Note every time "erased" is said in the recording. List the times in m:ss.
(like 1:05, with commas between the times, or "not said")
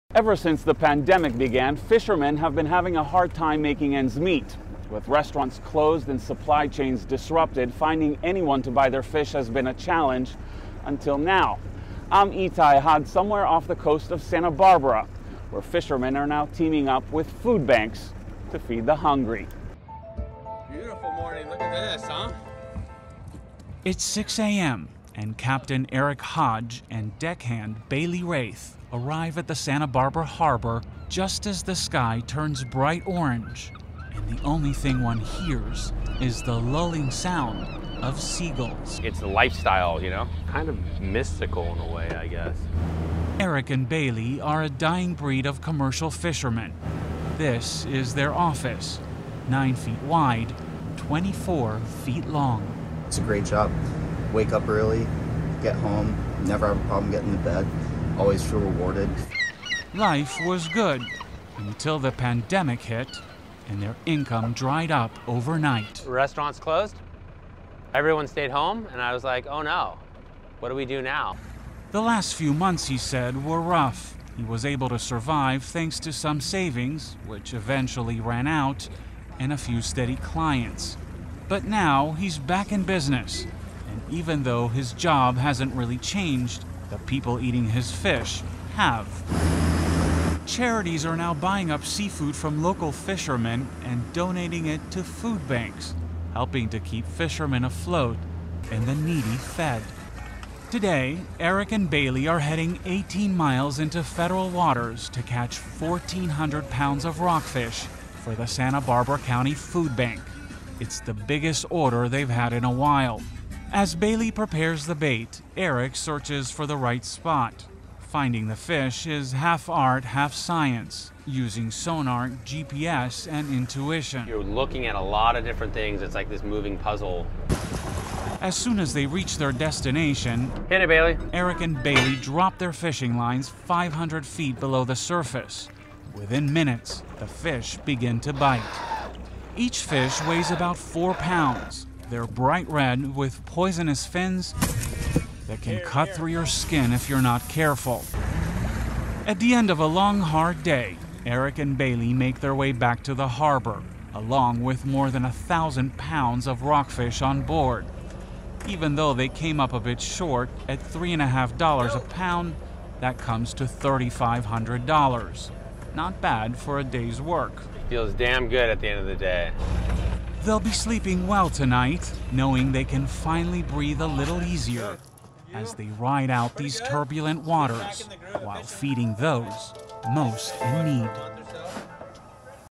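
not said.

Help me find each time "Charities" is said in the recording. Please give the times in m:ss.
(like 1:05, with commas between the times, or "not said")
1:30.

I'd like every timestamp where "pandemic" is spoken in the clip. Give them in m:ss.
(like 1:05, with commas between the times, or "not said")
0:00, 1:02.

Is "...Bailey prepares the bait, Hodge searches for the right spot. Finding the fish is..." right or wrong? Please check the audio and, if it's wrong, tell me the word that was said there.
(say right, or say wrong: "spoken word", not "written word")
wrong: "Eric", not "Hodge".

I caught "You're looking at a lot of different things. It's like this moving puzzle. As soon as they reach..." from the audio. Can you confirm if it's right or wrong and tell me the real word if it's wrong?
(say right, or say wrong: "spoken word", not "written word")
right.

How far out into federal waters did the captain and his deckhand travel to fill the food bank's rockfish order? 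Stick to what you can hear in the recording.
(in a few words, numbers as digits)
18 miles.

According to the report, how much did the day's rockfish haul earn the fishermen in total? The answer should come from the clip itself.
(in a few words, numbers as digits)
$3,500.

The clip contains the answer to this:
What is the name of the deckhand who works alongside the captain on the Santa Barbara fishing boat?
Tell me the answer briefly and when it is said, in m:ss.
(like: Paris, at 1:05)
Bailey Raith, at 0:27.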